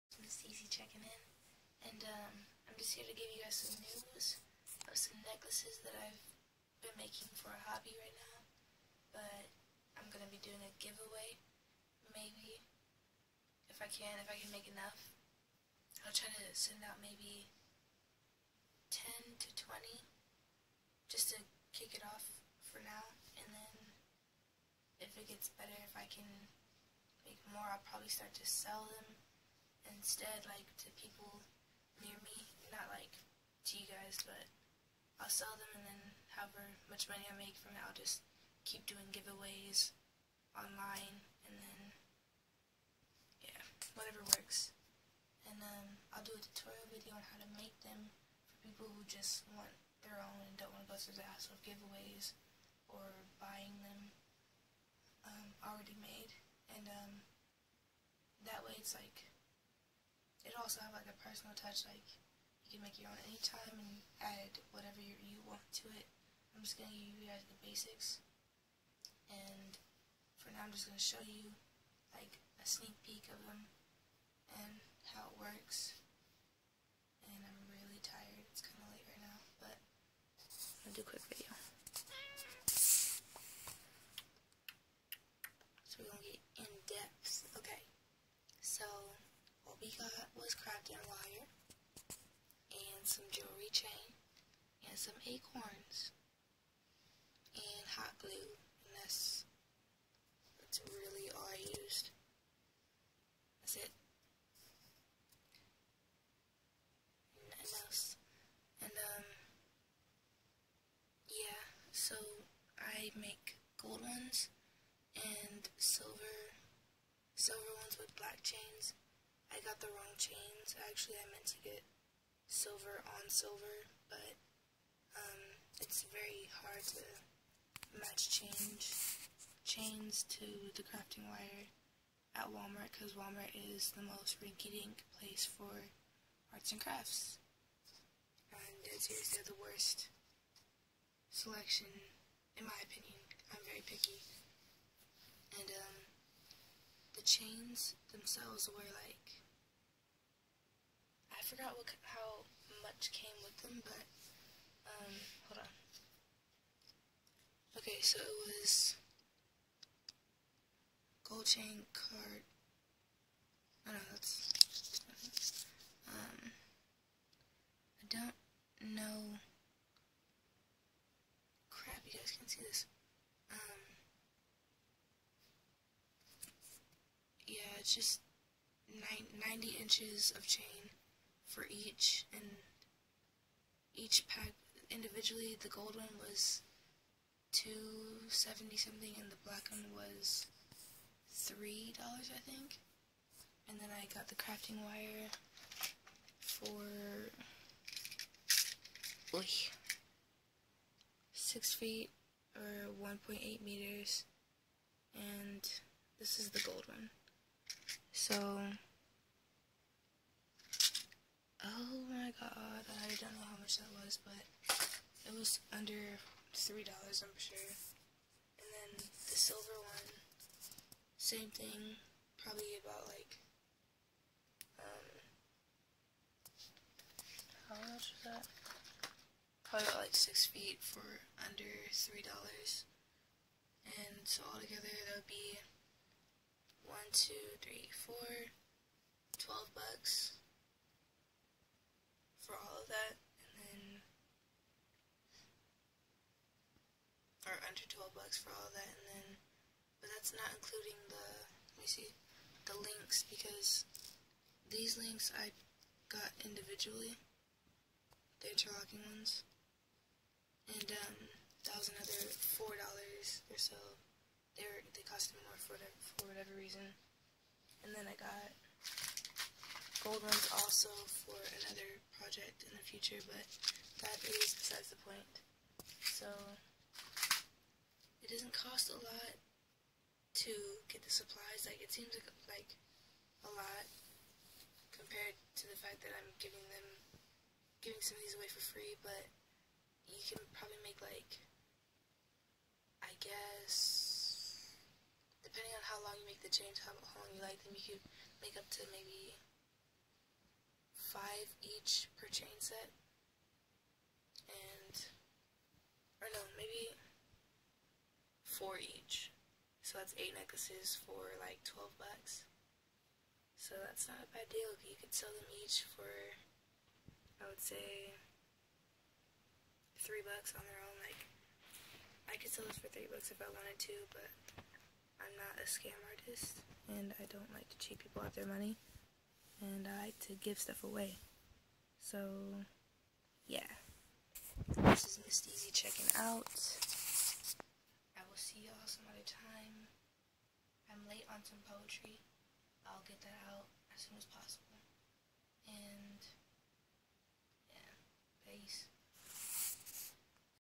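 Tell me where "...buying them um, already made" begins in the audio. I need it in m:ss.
0:53.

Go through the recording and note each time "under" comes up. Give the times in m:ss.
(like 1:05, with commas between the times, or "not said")
3:35, 3:51, 4:07.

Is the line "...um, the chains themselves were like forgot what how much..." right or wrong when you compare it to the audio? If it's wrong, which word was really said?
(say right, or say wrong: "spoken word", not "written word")
right.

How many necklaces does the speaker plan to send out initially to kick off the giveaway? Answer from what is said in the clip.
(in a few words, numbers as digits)
10 to 20.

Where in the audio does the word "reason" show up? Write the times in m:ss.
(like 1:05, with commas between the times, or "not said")
4:26.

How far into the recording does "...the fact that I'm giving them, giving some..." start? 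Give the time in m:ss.
4:45.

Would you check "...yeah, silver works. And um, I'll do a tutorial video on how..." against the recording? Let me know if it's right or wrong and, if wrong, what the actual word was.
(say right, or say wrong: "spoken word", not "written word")
wrong: "whatever", not "silver".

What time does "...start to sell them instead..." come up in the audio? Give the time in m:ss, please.
0:28.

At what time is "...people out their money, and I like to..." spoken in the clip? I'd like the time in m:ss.
5:28.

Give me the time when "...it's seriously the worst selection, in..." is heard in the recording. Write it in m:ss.
2:18.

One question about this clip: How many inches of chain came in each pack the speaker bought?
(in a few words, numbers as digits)
90.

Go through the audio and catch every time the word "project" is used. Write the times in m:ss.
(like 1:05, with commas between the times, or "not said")
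4:32.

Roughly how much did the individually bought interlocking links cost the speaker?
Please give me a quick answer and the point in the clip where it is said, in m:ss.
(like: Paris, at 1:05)
$4, at 4:22.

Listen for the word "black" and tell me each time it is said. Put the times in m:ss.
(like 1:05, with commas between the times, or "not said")
1:58, 3:09.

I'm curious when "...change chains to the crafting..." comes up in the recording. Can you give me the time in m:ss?
2:08.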